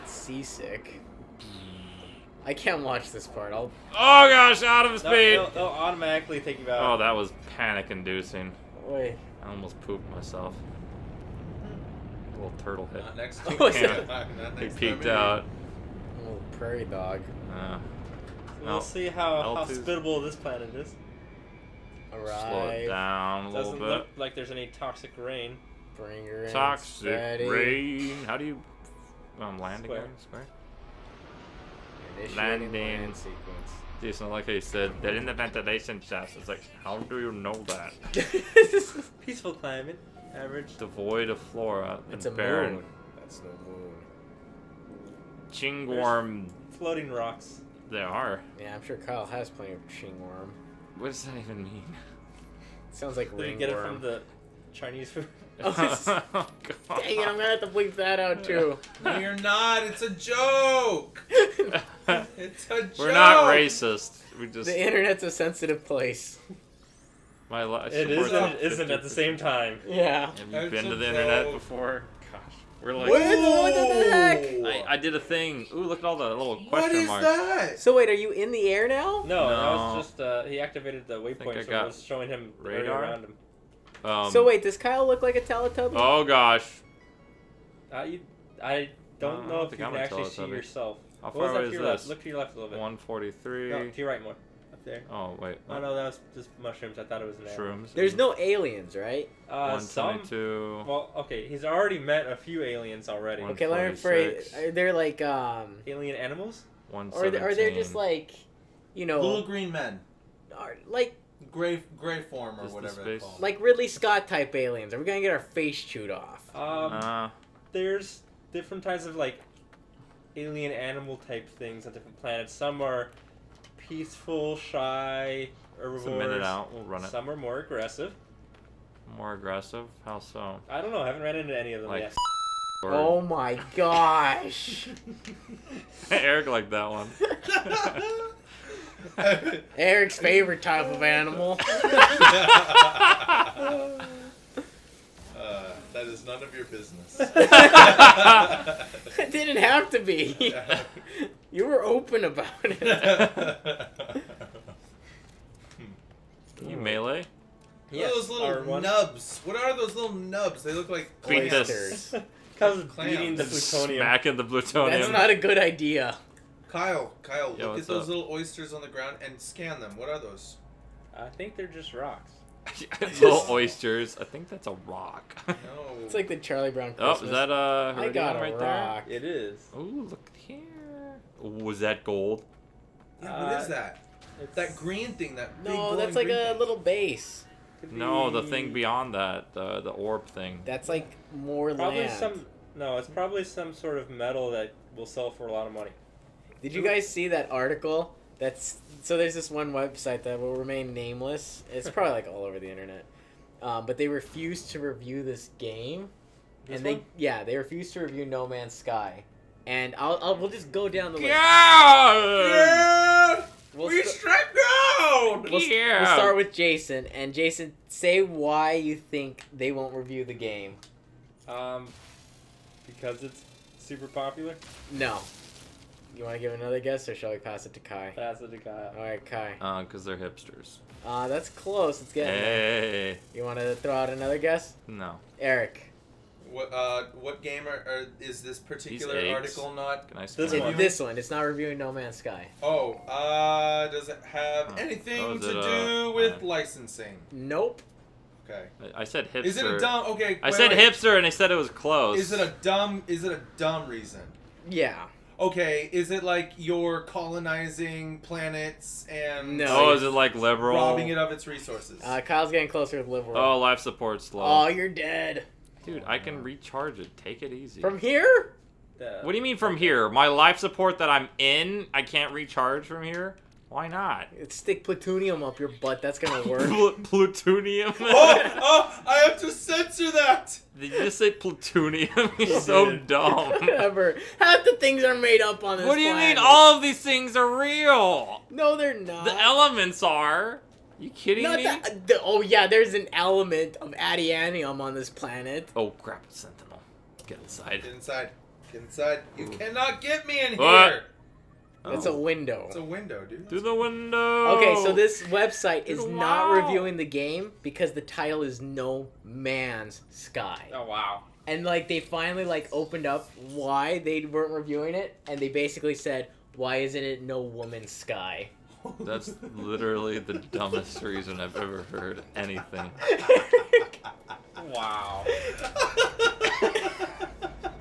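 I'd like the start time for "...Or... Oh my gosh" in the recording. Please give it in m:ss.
2:12.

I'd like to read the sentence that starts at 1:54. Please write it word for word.
Are we gonna get our face chewed off?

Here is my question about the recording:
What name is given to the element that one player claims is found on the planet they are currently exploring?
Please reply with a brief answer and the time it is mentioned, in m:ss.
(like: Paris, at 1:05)
adianium, at 4:53.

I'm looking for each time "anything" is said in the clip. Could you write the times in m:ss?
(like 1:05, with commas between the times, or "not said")
4:04, 5:22.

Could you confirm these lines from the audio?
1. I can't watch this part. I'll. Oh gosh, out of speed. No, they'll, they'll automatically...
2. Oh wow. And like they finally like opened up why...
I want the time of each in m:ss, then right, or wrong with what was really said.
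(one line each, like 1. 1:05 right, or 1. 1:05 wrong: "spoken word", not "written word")
1. 0:02 right
2. 5:10 right.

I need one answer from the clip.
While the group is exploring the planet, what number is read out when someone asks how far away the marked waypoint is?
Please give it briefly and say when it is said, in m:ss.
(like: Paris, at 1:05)
143, at 1:32.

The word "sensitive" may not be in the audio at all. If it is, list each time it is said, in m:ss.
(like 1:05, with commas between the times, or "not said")
1:05.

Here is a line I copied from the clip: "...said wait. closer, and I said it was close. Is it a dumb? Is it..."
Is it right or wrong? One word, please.
wrong.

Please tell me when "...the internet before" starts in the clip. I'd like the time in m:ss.
1:10.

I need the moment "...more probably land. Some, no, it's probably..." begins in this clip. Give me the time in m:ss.
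3:11.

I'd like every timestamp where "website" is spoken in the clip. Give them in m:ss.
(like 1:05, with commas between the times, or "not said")
3:19, 5:05.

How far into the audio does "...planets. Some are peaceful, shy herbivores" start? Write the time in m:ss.
2:02.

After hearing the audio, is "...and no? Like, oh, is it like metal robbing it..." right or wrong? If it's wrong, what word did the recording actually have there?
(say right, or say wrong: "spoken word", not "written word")
wrong: "liberal", not "metal".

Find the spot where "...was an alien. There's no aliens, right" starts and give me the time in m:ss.
1:37.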